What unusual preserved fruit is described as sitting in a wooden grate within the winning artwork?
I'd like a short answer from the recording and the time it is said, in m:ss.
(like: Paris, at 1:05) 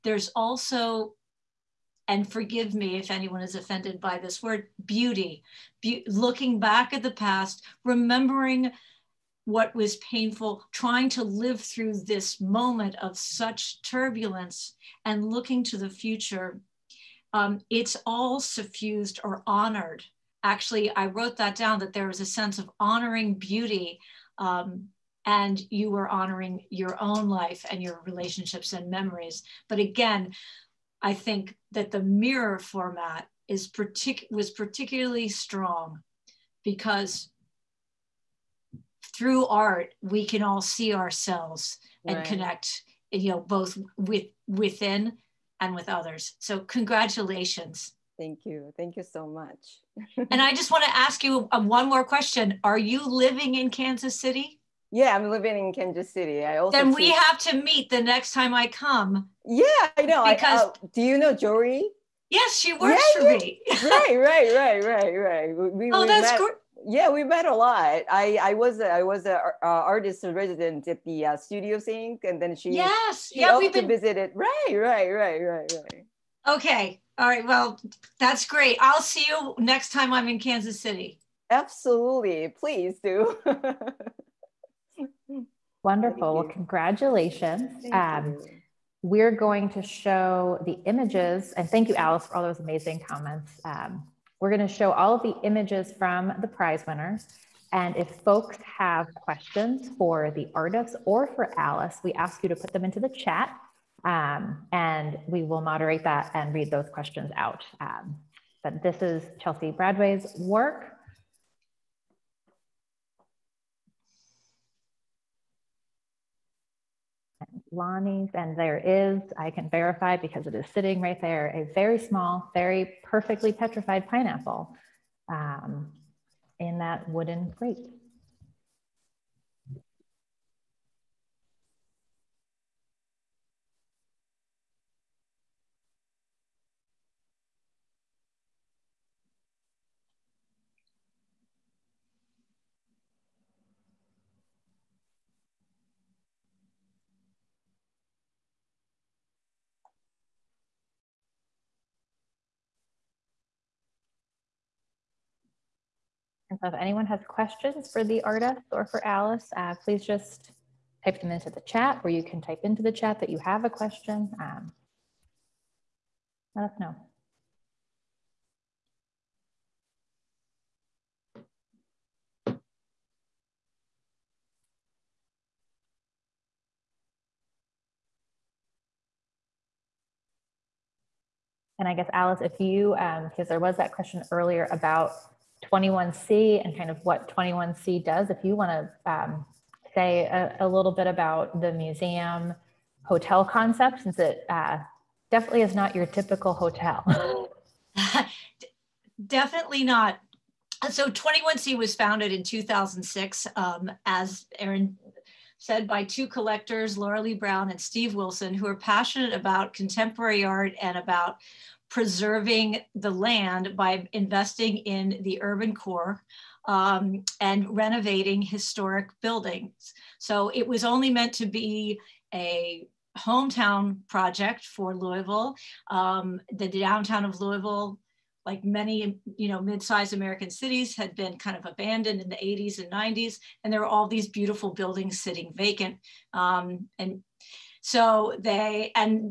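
pineapple, at 2:04.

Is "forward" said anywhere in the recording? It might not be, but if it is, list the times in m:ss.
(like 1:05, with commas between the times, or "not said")
not said.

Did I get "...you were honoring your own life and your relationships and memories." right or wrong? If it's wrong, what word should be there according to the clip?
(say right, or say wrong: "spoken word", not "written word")
right.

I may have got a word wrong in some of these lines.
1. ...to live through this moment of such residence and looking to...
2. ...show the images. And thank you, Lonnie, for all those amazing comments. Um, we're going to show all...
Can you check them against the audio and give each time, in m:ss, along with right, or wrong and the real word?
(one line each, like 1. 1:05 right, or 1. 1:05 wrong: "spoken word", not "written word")
1. 0:11 wrong: "turbulence", not "residence"
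2. 1:29 wrong: "Alice", not "Lonnie".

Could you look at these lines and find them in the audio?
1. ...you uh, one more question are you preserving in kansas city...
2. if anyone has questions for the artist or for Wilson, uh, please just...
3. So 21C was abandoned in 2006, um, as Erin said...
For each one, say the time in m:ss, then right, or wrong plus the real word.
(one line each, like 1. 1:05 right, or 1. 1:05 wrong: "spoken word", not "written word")
1. 0:51 wrong: "living", not "preserving"
2. 2:36 wrong: "Alice", not "Wilson"
3. 3:20 wrong: "founded", not "abandoned".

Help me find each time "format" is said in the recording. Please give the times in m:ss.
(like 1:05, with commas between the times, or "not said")
0:32.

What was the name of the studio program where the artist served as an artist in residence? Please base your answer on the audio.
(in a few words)
Studios Inc.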